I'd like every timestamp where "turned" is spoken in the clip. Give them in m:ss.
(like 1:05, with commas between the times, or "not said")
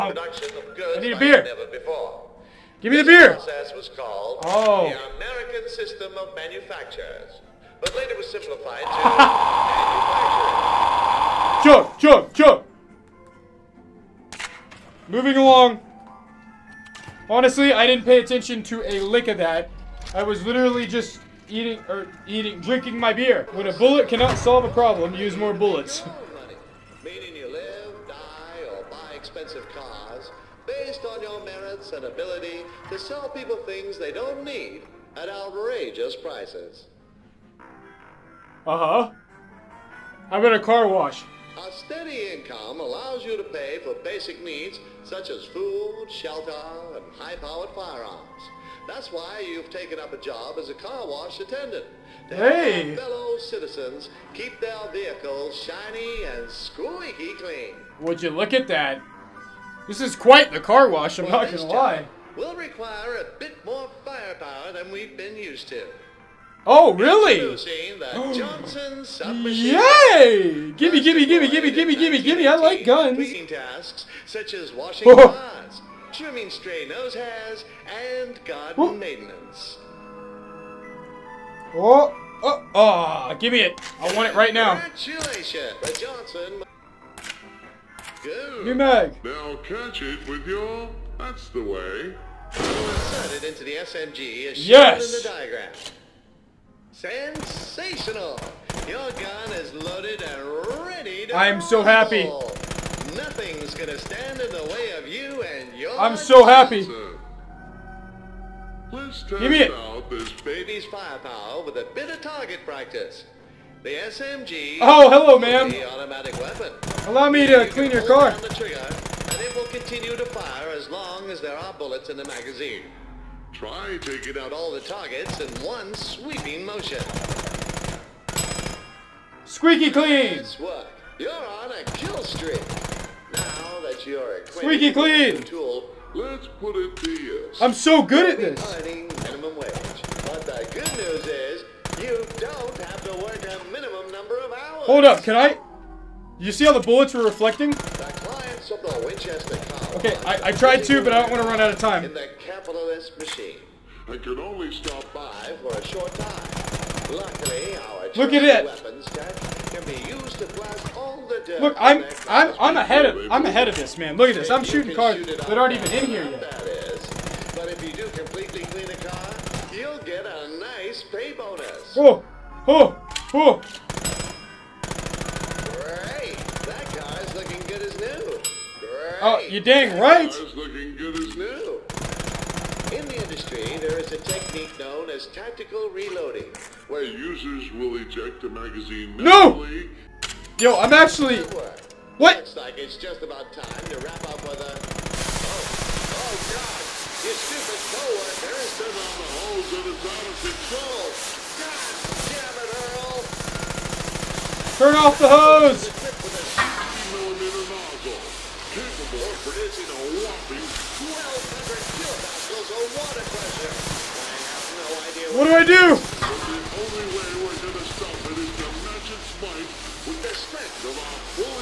3:18.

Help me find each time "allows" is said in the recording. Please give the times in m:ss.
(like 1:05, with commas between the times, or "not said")
0:42, 1:57.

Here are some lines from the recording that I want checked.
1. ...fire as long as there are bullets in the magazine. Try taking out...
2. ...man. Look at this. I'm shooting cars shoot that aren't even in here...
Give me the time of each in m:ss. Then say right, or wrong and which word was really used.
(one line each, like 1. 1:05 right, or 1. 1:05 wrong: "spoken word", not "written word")
1. 2:00 right
2. 2:43 right.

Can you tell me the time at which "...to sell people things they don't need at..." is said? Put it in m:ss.
0:32.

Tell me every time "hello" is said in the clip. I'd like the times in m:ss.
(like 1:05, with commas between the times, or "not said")
1:55.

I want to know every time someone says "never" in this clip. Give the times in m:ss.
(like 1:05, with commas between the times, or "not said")
0:01.